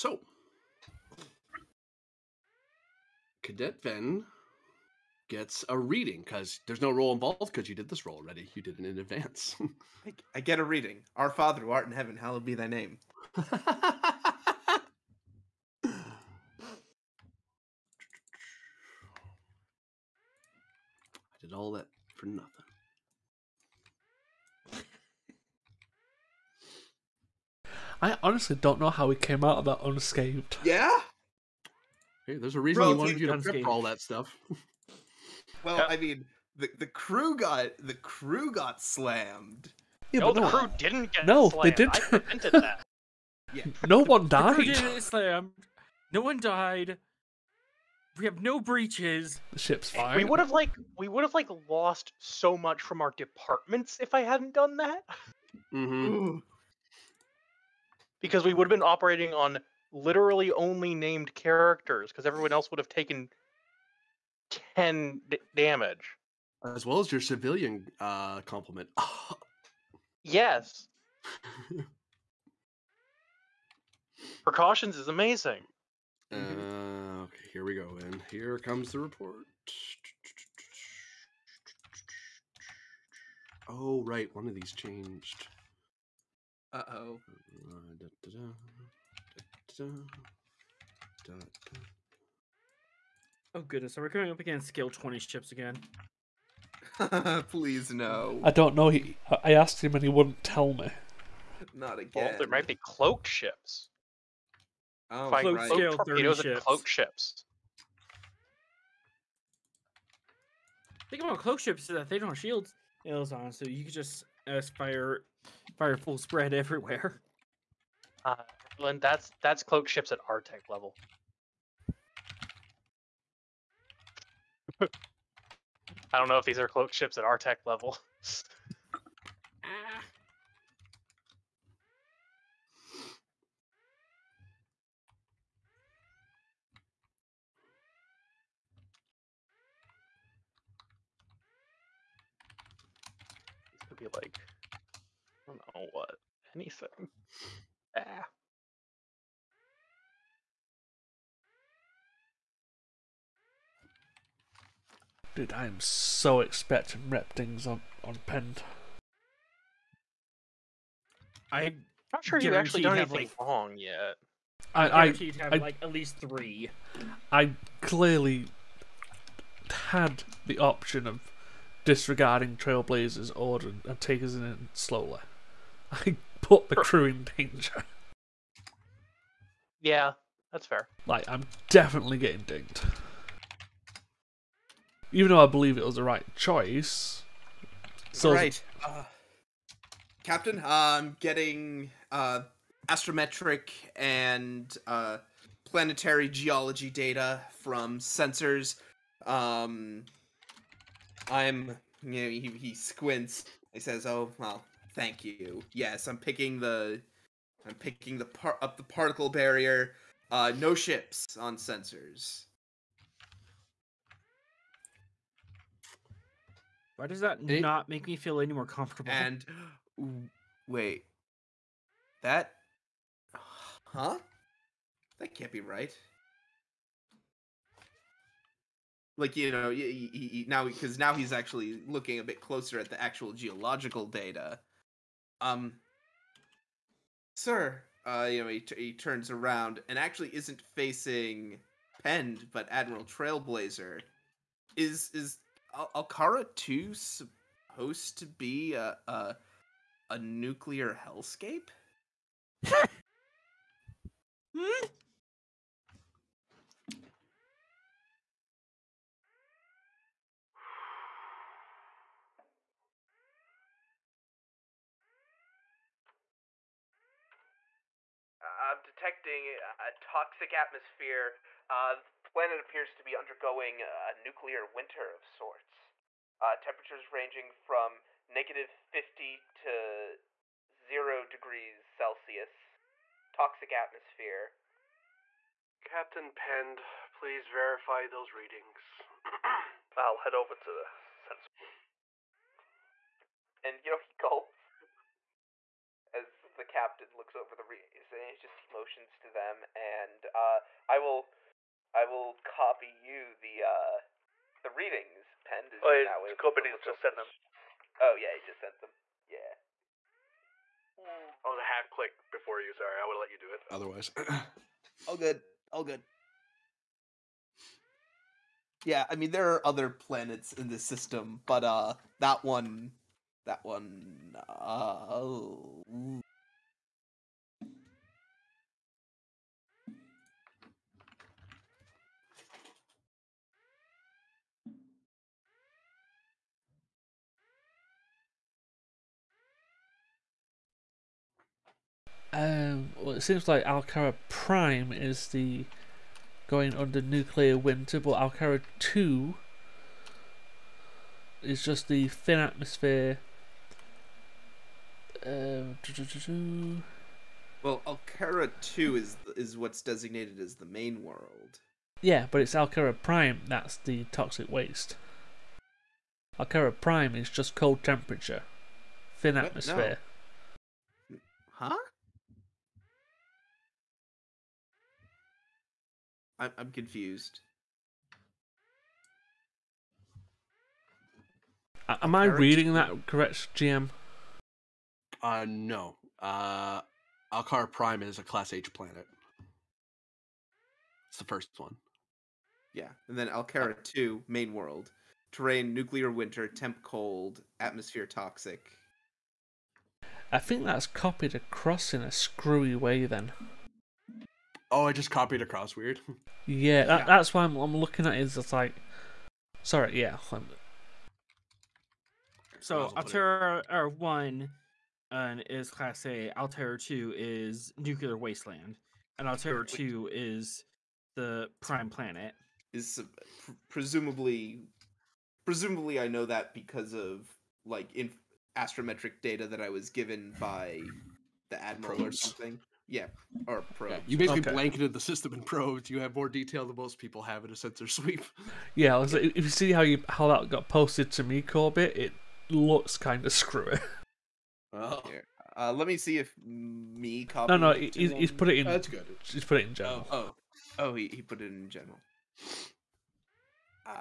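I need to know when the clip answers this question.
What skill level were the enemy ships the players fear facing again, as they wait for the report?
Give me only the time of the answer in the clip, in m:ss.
1:34.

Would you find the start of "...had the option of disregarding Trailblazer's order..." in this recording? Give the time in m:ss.
2:49.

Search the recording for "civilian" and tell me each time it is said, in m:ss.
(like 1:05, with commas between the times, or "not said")
1:07.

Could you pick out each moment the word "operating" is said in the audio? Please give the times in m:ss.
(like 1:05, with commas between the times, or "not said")
0:58.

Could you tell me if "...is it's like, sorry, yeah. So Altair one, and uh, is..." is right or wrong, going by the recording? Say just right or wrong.
right.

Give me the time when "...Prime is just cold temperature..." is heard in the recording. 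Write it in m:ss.
6:06.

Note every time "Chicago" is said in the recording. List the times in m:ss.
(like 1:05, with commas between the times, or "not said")
not said.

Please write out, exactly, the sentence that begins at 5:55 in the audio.
Um, doo -doo -doo well, Alcara 2 is is what's designated as the main world.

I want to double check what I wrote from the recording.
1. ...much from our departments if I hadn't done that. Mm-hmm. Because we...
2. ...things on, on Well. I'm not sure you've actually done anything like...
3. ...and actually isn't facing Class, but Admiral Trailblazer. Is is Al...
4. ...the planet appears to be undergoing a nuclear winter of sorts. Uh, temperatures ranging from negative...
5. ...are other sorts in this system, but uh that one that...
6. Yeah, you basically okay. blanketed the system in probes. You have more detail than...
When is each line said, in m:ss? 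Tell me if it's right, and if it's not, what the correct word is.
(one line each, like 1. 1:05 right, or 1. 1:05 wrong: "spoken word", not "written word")
1. 0:52 right
2. 2:37 wrong: "Pend", not "Well"
3. 3:59 wrong: "Pend", not "Class"
4. 4:32 right
5. 5:19 wrong: "planets", not "sorts"
6. 7:13 right.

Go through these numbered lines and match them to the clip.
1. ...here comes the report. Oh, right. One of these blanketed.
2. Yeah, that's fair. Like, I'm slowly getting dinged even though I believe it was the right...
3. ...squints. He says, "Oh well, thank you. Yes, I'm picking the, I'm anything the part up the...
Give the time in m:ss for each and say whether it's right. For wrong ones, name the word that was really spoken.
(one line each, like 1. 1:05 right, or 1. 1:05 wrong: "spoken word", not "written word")
1. 1:18 wrong: "changed", not "blanketed"
2. 2:59 wrong: "definitely", not "slowly"
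3. 3:22 wrong: "picking", not "anything".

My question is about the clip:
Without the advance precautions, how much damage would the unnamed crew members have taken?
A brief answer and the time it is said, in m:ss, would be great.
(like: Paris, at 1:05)
10, at 1:04.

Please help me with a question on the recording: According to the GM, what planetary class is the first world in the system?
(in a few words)
Class H.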